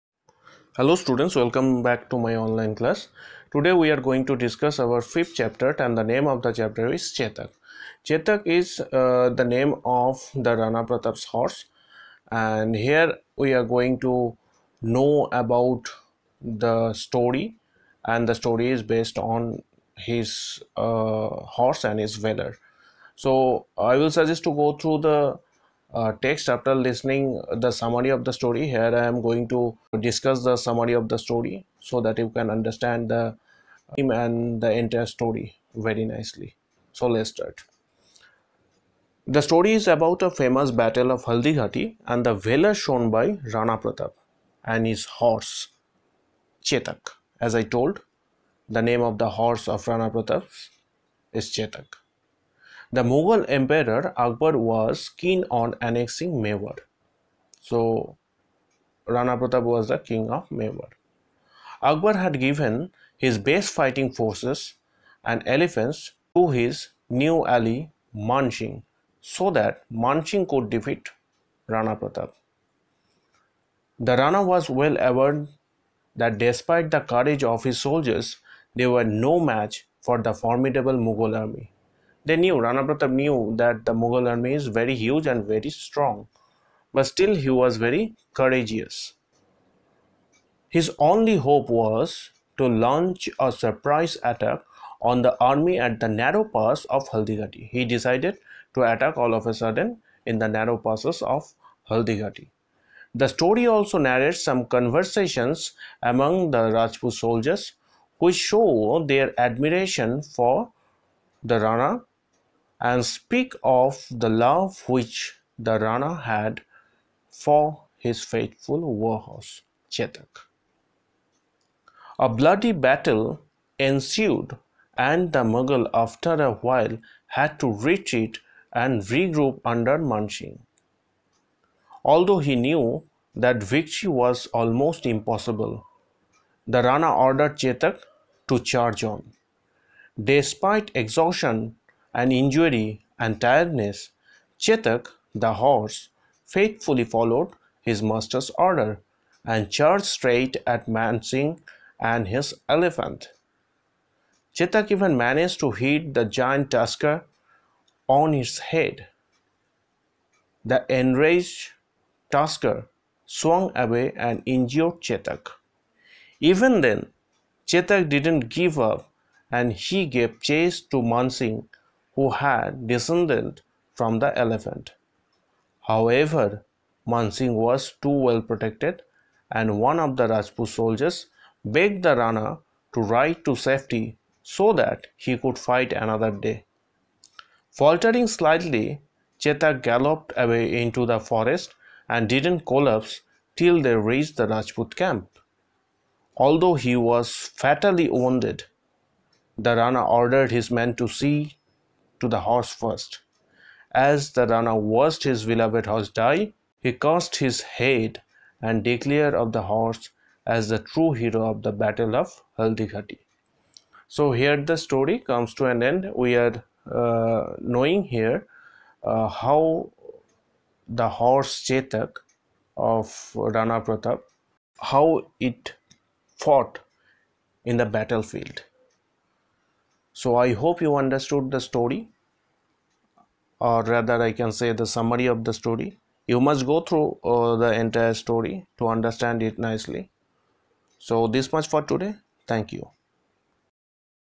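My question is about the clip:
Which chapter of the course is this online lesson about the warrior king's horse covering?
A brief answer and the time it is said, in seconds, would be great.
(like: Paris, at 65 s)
fifth, at 5 s.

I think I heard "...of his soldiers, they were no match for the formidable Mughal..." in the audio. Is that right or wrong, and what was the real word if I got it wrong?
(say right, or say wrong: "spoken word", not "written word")
right.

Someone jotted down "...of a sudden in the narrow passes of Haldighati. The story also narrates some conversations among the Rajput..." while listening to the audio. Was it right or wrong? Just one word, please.
right.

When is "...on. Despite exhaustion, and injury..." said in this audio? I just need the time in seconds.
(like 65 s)
139 s.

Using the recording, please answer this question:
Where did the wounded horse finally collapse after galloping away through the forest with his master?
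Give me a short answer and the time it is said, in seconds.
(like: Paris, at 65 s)
the Rajput camp, at 194 s.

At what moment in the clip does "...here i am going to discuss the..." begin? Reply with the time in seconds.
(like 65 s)
28 s.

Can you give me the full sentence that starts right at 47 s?
As I told, the name of the horse of Rana Pratap is Chetak.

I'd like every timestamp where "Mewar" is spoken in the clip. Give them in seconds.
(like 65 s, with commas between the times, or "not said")
56 s, 60 s.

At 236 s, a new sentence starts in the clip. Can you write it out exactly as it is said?
You must go through uh, the entire story to understand it nicely.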